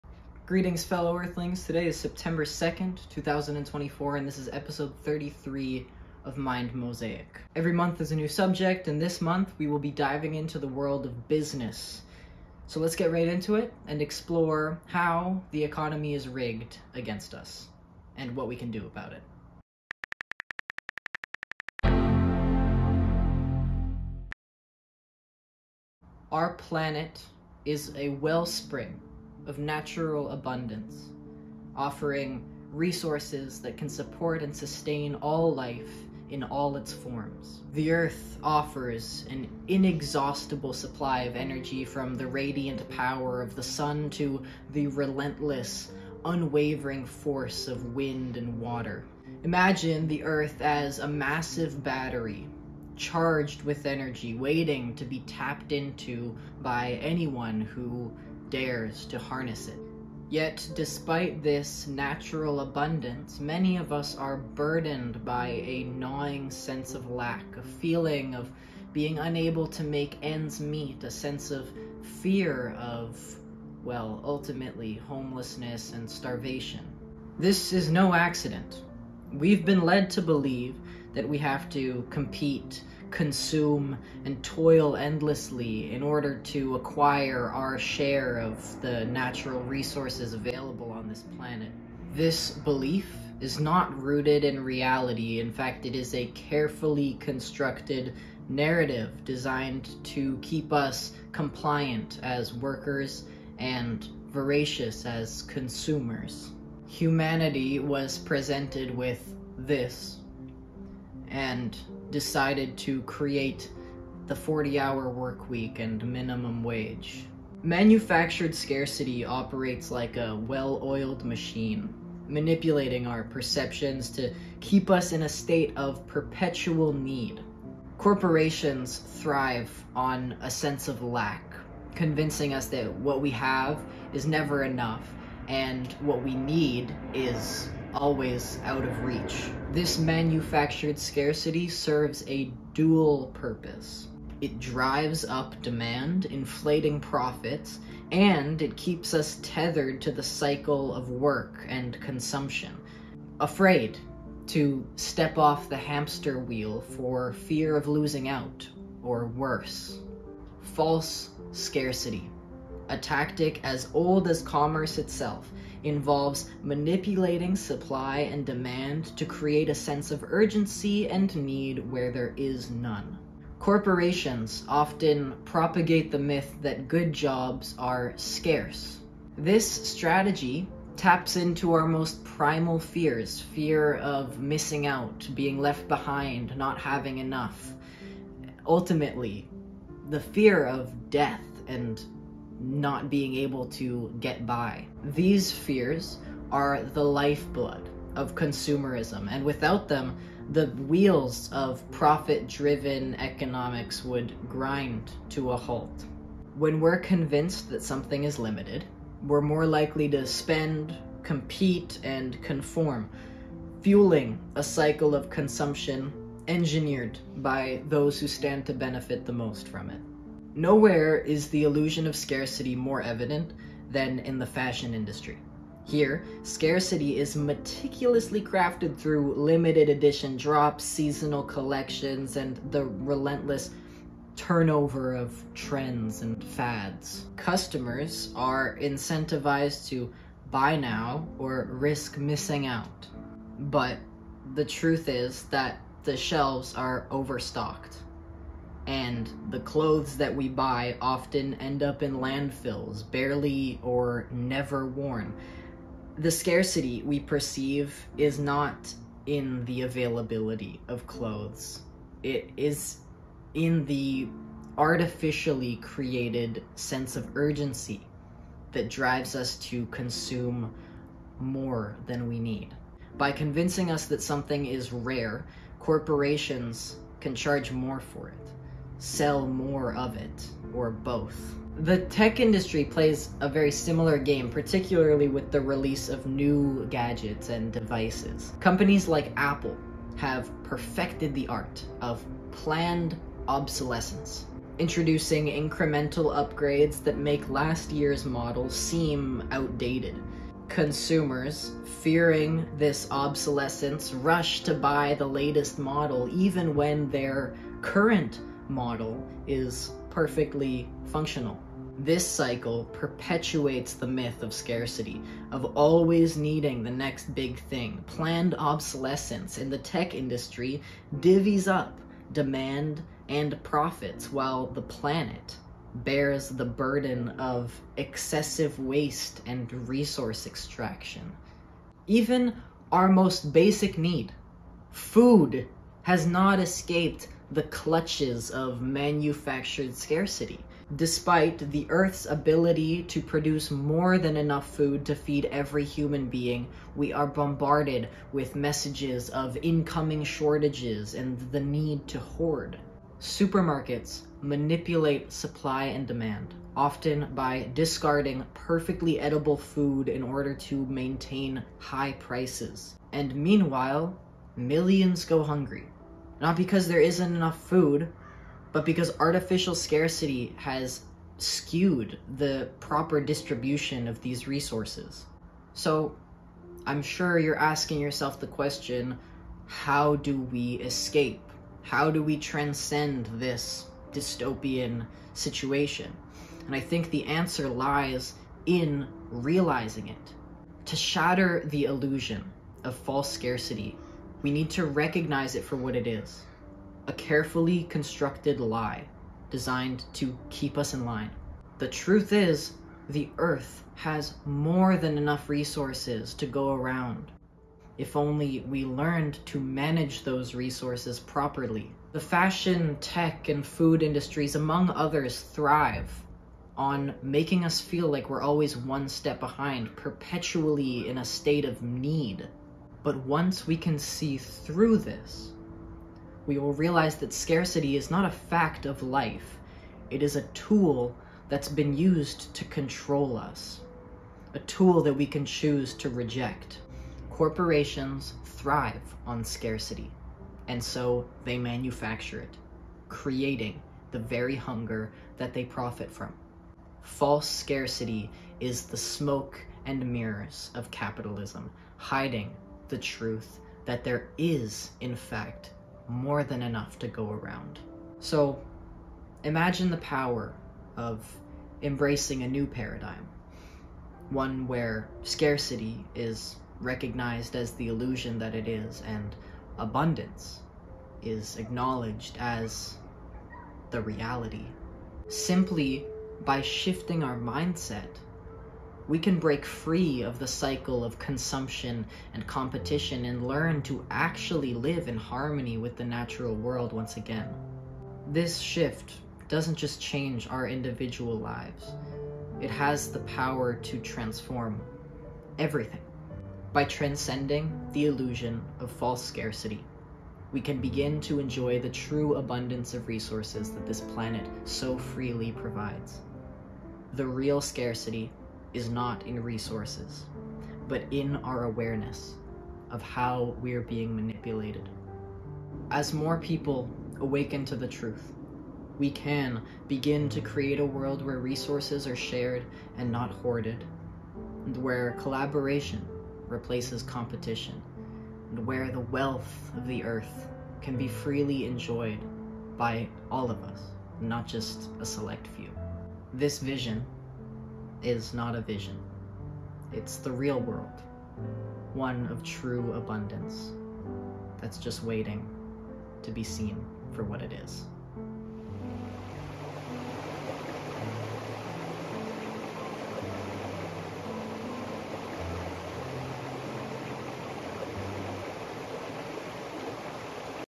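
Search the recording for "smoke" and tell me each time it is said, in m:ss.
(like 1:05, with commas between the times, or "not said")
7:28.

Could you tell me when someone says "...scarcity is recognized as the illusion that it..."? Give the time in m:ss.
7:45.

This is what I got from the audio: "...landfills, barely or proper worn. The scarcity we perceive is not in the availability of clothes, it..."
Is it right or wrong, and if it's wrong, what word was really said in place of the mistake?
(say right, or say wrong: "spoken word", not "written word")
wrong: "never", not "proper".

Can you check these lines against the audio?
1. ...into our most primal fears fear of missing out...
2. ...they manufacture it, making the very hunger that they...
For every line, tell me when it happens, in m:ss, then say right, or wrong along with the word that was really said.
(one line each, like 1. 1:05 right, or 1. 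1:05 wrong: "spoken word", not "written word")
1. 3:01 right
2. 7:21 wrong: "creating", not "making".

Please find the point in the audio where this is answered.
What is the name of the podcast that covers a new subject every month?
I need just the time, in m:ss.
0:06.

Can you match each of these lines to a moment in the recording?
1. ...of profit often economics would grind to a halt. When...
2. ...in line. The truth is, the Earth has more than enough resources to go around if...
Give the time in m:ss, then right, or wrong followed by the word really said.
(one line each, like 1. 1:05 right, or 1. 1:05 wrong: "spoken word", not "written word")
1. 3:21 wrong: "driven", not "often"
2. 6:40 right.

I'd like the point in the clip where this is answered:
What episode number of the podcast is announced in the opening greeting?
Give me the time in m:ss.
0:04.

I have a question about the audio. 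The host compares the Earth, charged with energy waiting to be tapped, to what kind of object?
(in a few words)
a massive battery.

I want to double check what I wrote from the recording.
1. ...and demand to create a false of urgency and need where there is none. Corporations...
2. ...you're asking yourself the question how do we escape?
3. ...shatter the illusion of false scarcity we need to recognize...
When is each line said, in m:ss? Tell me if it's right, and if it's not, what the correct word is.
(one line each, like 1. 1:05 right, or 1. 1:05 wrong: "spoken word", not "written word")
1. 2:48 wrong: "sense", not "false"
2. 6:17 right
3. 6:30 right.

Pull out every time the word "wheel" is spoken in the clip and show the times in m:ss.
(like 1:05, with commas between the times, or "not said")
2:36, 3:20.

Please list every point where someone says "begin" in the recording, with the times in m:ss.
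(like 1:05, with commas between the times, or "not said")
8:20, 8:39.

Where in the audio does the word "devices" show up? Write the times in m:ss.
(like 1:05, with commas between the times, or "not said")
4:47.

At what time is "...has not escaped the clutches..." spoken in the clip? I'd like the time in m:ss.
5:36.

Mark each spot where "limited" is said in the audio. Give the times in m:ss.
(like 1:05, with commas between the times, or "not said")
3:28, 3:49.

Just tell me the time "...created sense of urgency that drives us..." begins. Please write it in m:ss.
4:25.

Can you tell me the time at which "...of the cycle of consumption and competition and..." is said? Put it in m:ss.
8:00.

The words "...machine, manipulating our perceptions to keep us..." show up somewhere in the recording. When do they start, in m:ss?
2:01.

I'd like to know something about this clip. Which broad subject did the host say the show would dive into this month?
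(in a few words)
business.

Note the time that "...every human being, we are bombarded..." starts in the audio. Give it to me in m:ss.
5:45.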